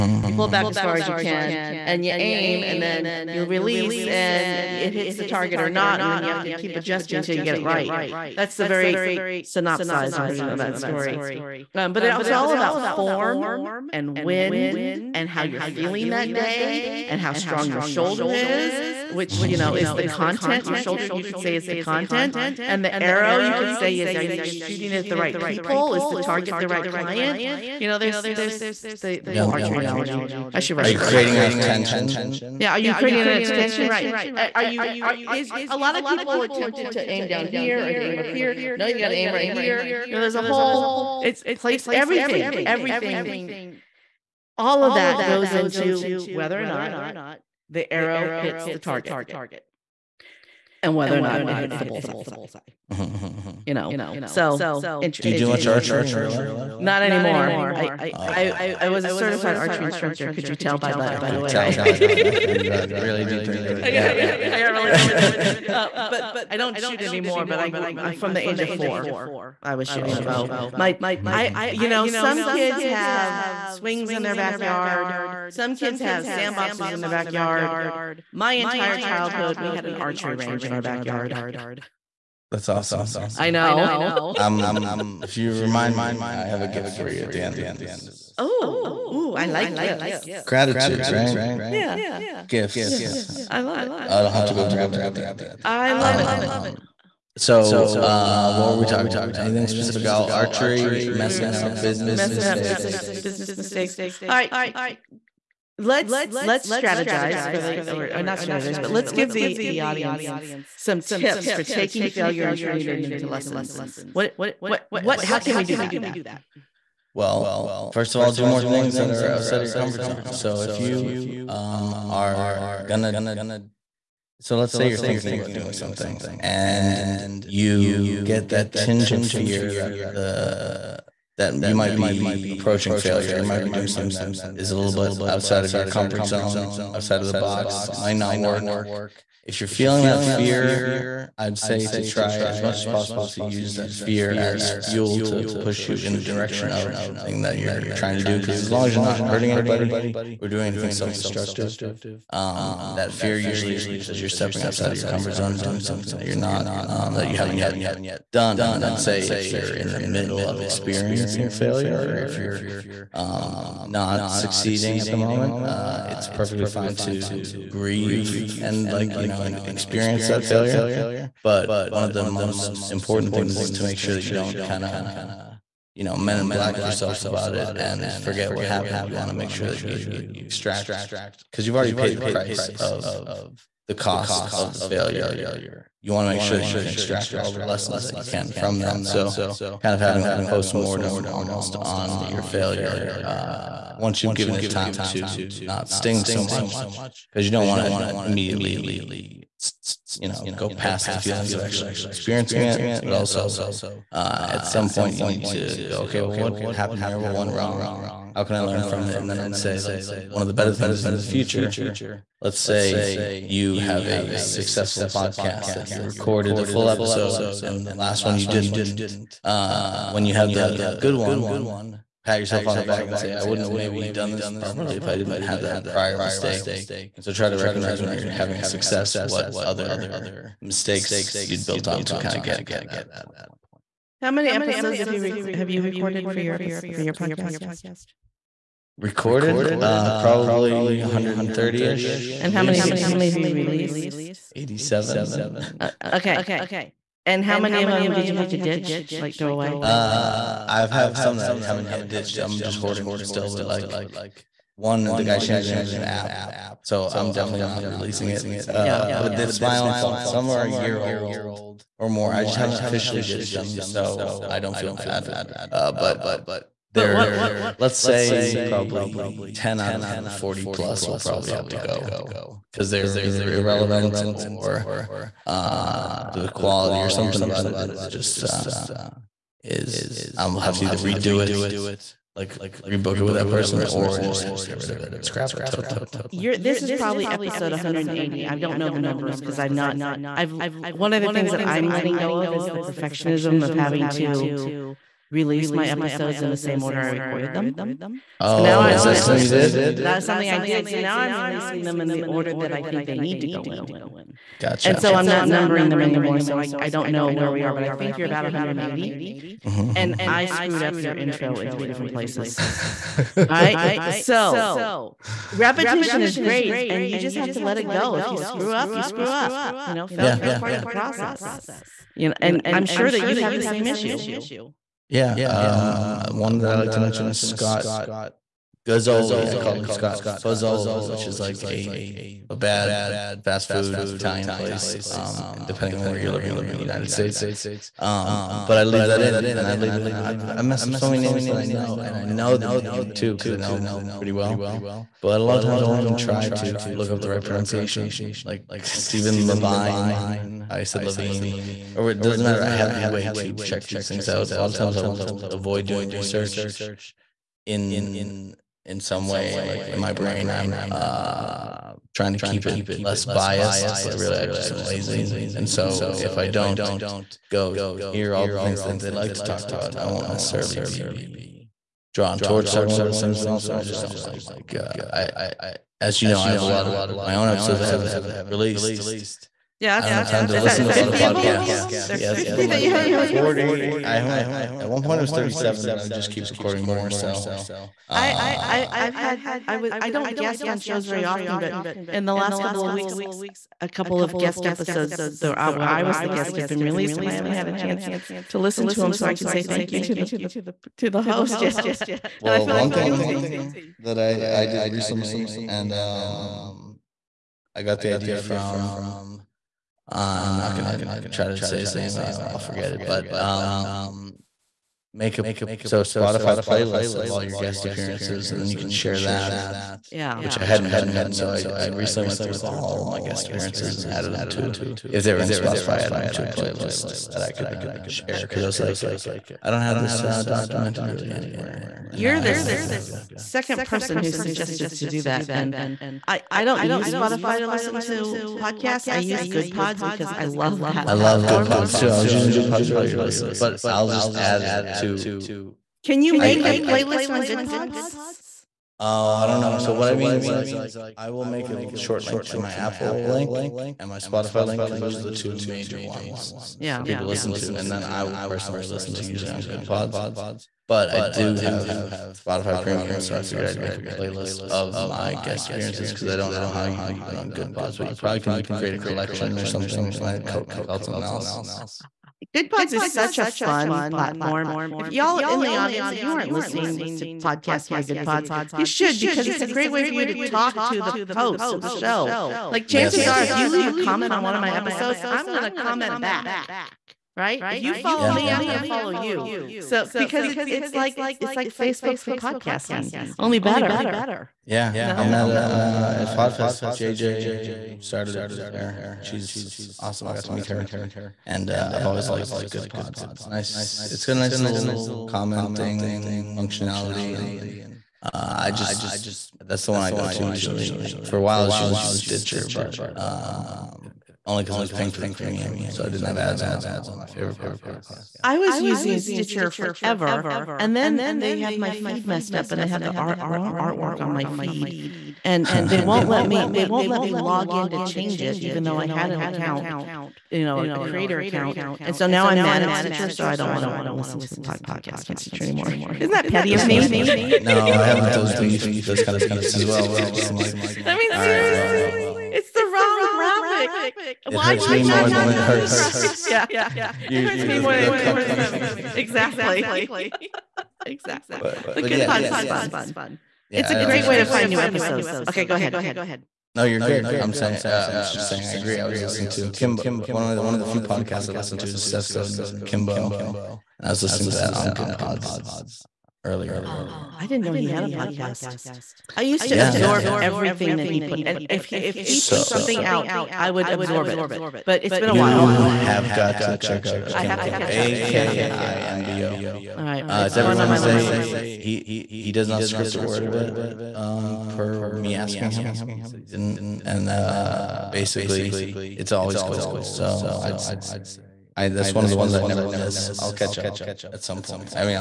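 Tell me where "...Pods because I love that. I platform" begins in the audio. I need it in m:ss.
7:19.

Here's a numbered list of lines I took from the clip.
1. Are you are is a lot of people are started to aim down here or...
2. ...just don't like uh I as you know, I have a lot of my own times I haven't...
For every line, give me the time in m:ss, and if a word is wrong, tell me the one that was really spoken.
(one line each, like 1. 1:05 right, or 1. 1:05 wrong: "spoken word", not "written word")
1. 0:34 wrong: "tempted", not "started"
2. 6:13 wrong: "episodes", not "times".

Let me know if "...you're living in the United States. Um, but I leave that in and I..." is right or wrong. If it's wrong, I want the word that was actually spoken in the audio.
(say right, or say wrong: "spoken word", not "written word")
right.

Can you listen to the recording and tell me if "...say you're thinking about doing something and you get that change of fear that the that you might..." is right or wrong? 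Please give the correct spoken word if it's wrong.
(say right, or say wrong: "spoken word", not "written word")
wrong: "tinge", not "change".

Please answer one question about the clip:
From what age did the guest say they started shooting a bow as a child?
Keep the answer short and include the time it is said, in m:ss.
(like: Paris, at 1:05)
4, at 1:08.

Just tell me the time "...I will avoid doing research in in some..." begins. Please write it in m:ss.
5:54.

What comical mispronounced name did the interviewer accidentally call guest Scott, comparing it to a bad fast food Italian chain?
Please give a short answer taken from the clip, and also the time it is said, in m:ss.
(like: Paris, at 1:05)
Scott Fuzzoli, at 5:29.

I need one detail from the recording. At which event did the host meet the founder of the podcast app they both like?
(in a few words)
Podfest.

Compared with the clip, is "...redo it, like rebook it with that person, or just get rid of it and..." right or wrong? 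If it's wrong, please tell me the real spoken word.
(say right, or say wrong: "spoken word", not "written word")
right.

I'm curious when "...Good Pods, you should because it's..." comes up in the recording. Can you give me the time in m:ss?
7:58.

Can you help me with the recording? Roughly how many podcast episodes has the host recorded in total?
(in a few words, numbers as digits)
130.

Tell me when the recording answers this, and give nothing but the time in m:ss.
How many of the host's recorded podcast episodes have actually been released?
4:04.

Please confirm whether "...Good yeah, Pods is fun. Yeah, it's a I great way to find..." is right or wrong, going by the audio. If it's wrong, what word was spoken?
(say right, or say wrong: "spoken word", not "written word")
right.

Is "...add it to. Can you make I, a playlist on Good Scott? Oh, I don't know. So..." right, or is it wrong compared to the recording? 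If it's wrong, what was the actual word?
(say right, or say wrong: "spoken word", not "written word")
wrong: "Pods", not "Scott".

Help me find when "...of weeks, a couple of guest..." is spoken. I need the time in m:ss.
6:32.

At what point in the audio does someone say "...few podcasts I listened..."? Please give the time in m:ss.
9:20.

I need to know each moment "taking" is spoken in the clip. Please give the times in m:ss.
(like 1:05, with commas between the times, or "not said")
1:51.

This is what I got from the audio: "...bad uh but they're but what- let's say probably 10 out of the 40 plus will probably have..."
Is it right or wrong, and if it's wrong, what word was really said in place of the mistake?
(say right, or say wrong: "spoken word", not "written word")
right.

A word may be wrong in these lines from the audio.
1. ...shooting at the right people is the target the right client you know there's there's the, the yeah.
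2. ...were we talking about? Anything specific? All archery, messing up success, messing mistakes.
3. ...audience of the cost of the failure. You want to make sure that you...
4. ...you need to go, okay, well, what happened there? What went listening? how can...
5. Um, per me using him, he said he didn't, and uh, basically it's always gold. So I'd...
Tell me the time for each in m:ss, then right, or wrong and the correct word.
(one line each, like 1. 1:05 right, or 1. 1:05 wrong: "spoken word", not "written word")
1. 0:24 right
2. 1:38 wrong: "business", not "success"
3. 3:02 wrong: "price", not "audience"
4. 3:25 wrong: "wrong", not "listening"
5. 9:44 wrong: "asking", not "using".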